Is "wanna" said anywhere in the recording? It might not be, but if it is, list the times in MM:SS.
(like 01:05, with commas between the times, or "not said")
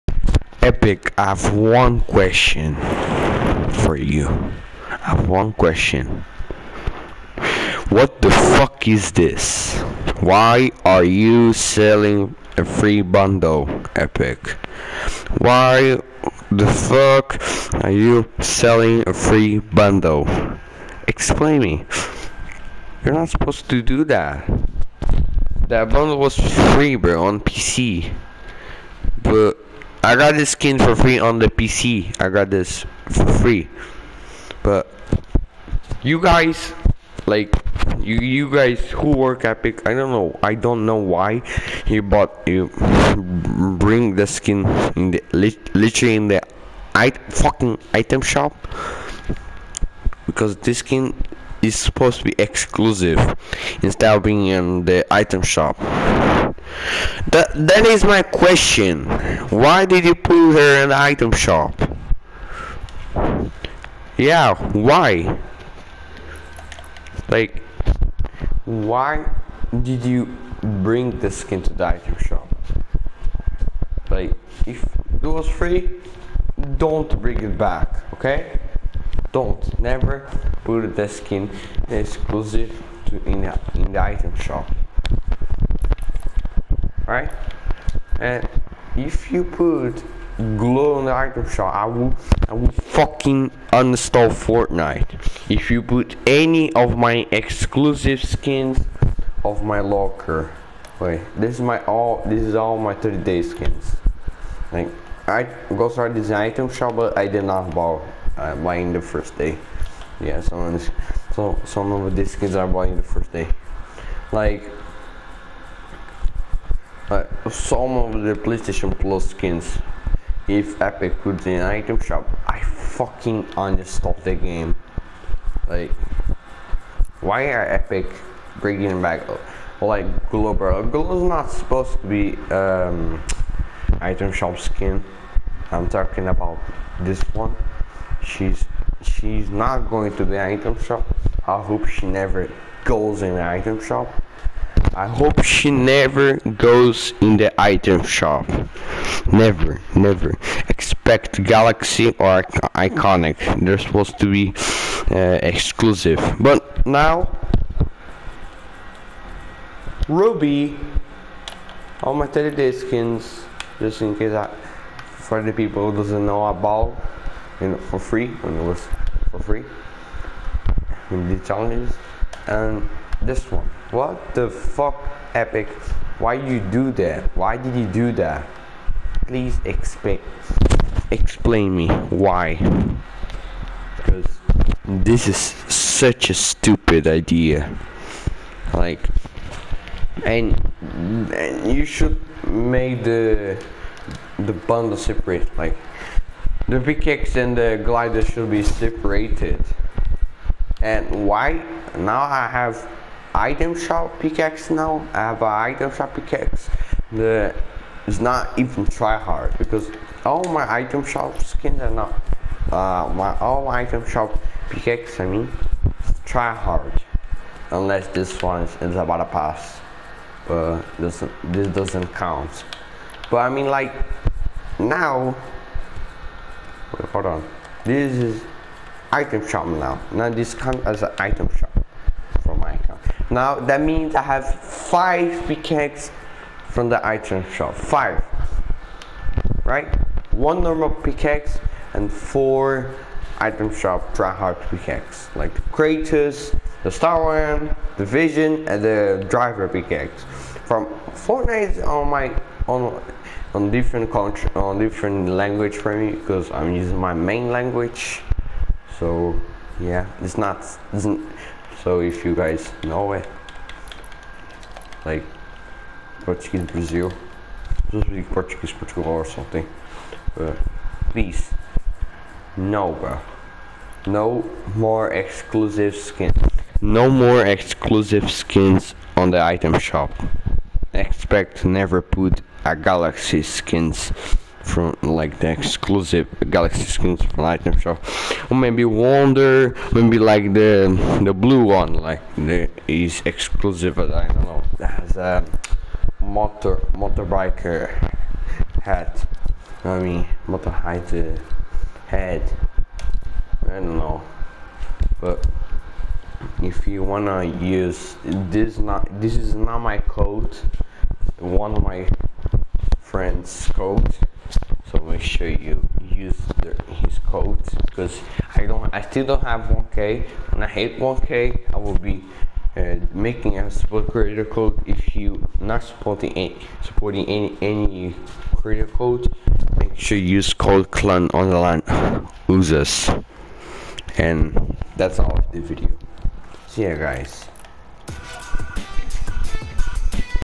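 05:07.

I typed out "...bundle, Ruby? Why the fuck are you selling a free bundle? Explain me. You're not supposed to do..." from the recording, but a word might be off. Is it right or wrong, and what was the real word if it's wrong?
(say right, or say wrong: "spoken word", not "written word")
wrong: "Epic", not "Ruby".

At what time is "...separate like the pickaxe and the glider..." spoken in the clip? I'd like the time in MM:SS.
03:14.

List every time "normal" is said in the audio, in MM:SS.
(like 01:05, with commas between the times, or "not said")
04:00.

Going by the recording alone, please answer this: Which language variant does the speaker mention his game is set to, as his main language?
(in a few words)
Portuguese Brazil.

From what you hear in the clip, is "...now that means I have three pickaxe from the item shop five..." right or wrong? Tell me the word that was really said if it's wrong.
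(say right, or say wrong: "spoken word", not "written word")
wrong: "five", not "three".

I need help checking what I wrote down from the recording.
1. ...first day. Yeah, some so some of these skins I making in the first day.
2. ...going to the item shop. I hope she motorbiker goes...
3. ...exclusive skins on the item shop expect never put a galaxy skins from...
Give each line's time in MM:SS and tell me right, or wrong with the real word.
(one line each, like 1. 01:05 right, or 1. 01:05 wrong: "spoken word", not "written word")
1. 01:49 wrong: "buying", not "making"
2. 02:19 wrong: "never", not "motorbiker"
3. 04:37 right.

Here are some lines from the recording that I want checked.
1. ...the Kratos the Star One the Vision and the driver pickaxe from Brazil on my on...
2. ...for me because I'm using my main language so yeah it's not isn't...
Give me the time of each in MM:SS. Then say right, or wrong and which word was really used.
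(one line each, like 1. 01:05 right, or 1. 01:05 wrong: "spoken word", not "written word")
1. 04:05 wrong: "Fortnite", not "Brazil"
2. 04:15 right.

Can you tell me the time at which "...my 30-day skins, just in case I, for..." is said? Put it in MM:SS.
02:42.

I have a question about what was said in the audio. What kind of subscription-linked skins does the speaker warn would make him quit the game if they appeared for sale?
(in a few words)
PlayStation Plus.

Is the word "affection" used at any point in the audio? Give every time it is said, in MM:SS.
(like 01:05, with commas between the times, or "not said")
not said.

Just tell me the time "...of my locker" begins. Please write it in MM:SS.
01:39.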